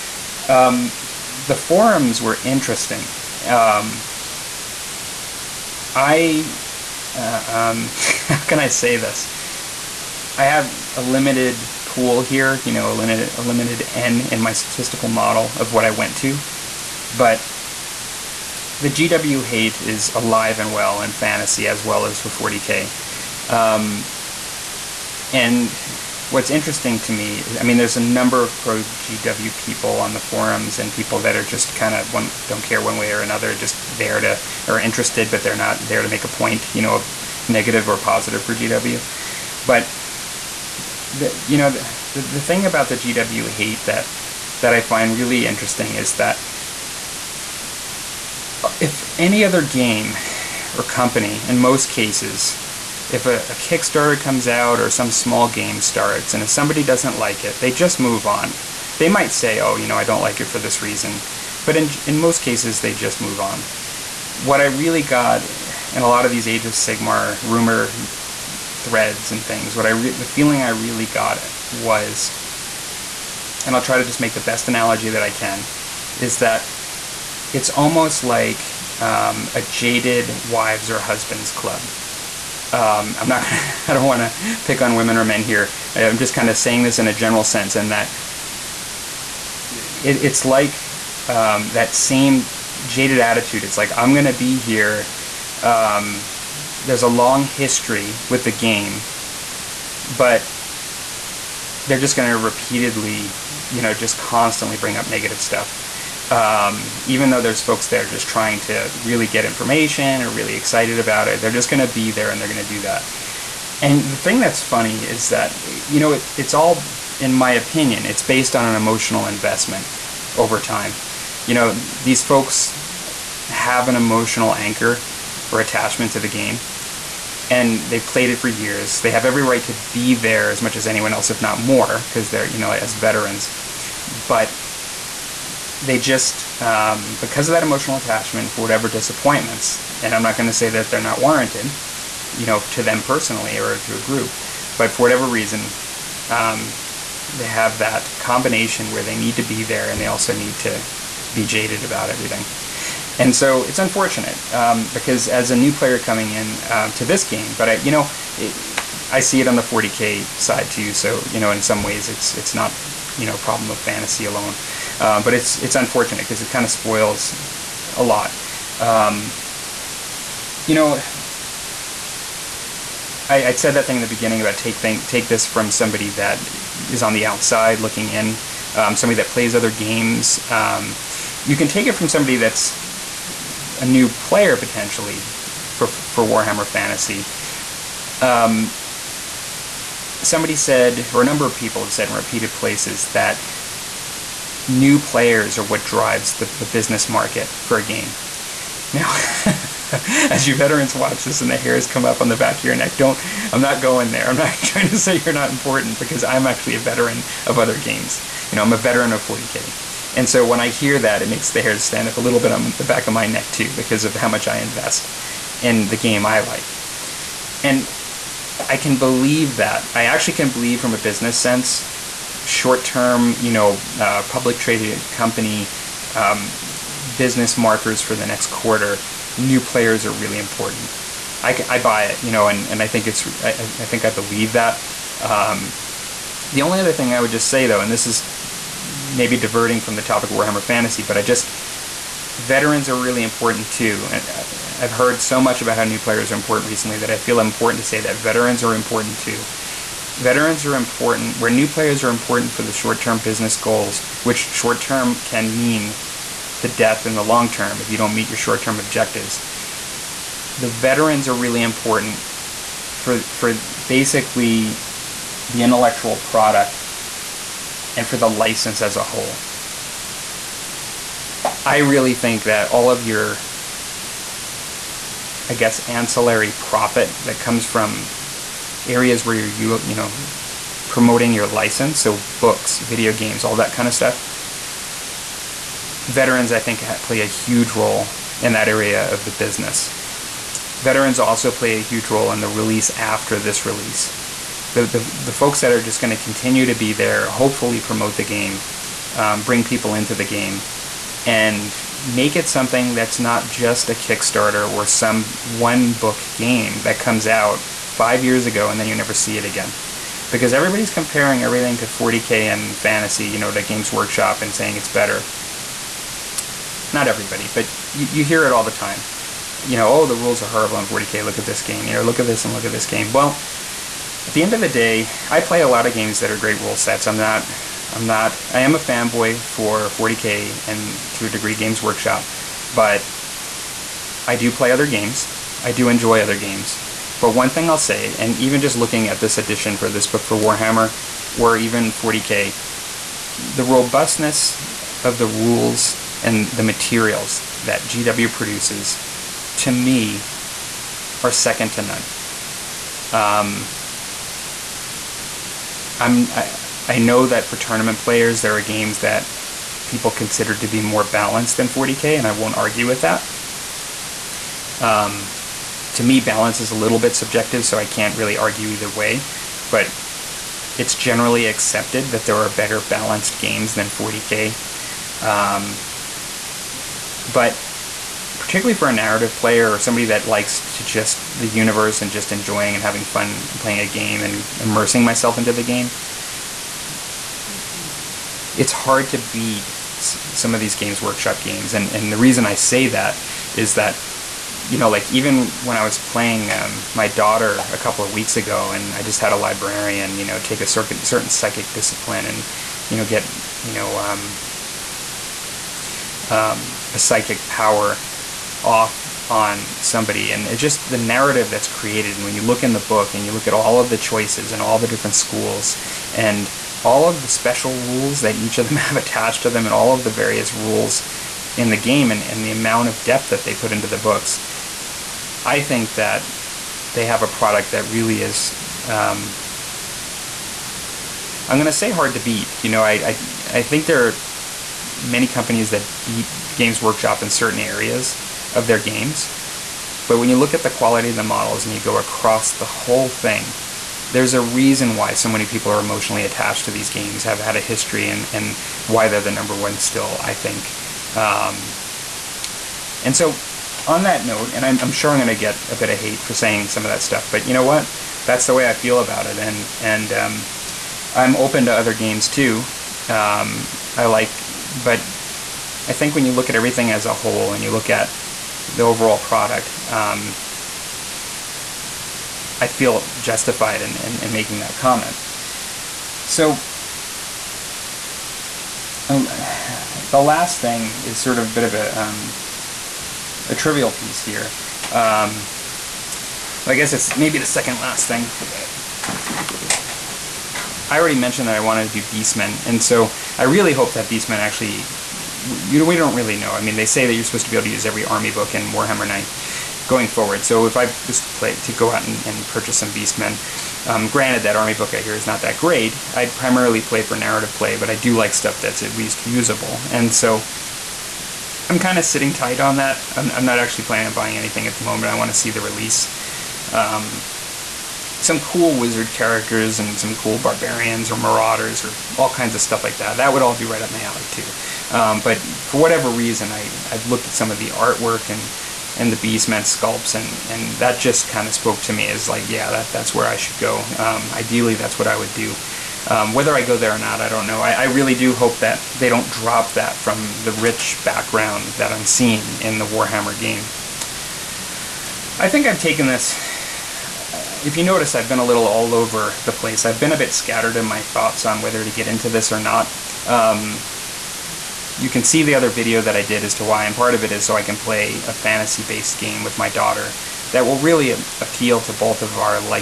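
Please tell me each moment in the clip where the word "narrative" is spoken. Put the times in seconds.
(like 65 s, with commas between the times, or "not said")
378 s, 410 s, 507 s.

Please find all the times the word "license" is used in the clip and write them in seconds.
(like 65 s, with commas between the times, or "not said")
268 s, 281 s.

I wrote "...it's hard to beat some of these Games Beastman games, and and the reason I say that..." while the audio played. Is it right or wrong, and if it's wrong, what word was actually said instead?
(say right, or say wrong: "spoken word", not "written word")
wrong: "Workshop", not "Beastman".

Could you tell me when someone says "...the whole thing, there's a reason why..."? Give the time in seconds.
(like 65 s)
442 s.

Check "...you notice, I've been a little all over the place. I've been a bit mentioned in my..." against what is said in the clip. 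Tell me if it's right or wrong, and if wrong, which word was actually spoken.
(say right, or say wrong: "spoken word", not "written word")
wrong: "scattered", not "mentioned".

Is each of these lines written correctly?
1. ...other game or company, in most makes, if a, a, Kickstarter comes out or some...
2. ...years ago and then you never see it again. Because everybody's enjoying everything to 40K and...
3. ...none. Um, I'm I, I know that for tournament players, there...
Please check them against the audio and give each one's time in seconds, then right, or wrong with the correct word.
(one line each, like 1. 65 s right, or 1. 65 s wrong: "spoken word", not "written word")
1. 49 s wrong: "cases", not "makes"
2. 308 s wrong: "comparing", not "enjoying"
3. 351 s right.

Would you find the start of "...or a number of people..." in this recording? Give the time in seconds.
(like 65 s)
191 s.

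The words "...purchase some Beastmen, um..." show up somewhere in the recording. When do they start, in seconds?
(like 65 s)
502 s.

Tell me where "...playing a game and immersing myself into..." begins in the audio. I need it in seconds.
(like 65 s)
383 s.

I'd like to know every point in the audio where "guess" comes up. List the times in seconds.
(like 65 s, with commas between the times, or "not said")
275 s, 486 s.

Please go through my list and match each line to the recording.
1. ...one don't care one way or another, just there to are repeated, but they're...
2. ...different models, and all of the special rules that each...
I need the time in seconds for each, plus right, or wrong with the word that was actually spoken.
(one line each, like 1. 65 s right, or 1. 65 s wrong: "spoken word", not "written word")
1. 32 s wrong: "interested", not "repeated"
2. 414 s wrong: "schools", not "models".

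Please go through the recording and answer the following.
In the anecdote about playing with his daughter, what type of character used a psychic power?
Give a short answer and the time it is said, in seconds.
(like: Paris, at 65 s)
librarian, at 399 s.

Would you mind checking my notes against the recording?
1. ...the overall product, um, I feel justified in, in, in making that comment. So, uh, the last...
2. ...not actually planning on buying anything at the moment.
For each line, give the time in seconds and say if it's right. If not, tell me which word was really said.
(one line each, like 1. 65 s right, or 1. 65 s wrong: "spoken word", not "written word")
1. 468 s right
2. 513 s right.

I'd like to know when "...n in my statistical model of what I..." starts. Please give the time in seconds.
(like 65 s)
13 s.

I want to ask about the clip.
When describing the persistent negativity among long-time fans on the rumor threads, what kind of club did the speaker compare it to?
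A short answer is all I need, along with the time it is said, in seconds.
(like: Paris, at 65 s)
jaded wives or husbands club, at 79 s.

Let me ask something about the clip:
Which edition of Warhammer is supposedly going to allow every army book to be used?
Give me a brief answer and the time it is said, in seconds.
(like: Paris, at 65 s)
Warhammer 9th, at 498 s.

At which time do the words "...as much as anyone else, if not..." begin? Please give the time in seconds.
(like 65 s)
130 s.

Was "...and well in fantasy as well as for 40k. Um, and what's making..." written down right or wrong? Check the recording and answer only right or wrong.
wrong.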